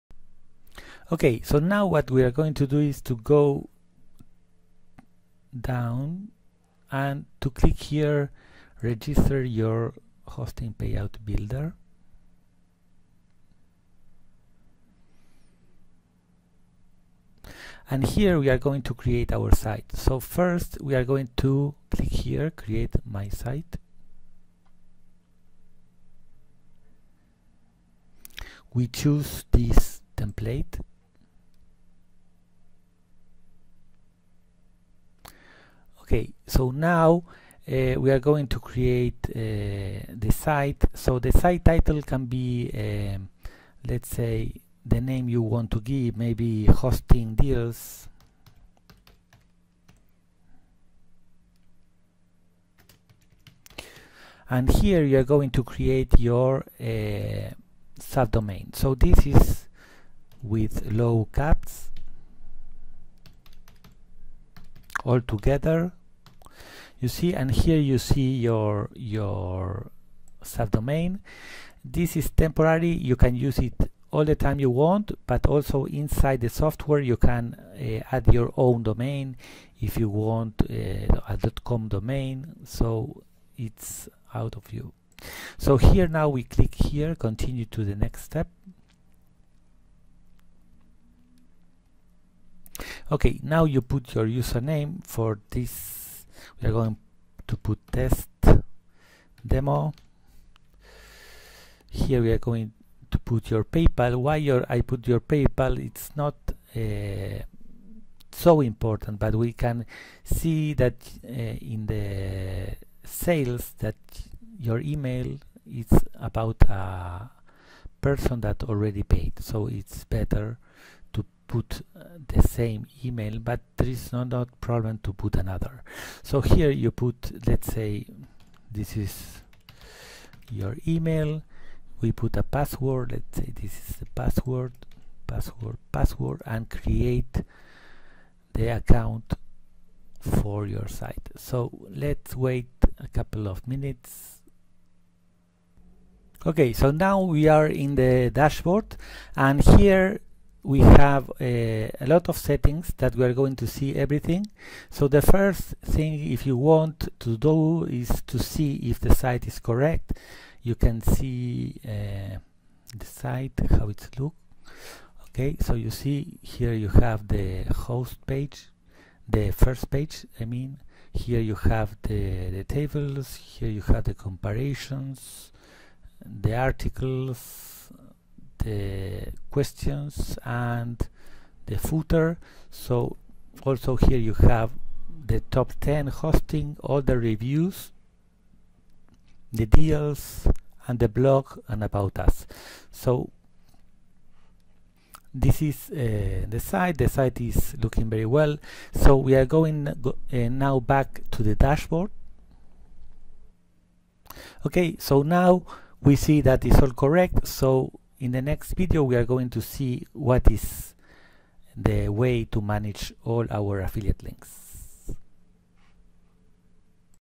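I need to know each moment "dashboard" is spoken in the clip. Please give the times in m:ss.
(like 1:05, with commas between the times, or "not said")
2:28, 3:21.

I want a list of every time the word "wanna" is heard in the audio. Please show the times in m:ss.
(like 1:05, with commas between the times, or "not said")
not said.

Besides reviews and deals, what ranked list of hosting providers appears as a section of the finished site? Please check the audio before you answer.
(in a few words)
top 10 hosting.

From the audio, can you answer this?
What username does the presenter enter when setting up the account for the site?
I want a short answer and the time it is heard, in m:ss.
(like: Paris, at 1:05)
test demo, at 1:37.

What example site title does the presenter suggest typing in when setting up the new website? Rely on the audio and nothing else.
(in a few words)
hosting deals.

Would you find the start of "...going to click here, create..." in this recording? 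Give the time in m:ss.
0:21.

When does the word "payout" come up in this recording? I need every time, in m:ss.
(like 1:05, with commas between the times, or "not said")
0:10.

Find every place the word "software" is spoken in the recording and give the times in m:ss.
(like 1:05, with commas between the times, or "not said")
1:16.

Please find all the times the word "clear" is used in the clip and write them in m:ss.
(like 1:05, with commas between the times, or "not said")
not said.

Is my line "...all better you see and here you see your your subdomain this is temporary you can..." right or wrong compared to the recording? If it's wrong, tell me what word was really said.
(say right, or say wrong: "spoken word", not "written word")
wrong: "together", not "better".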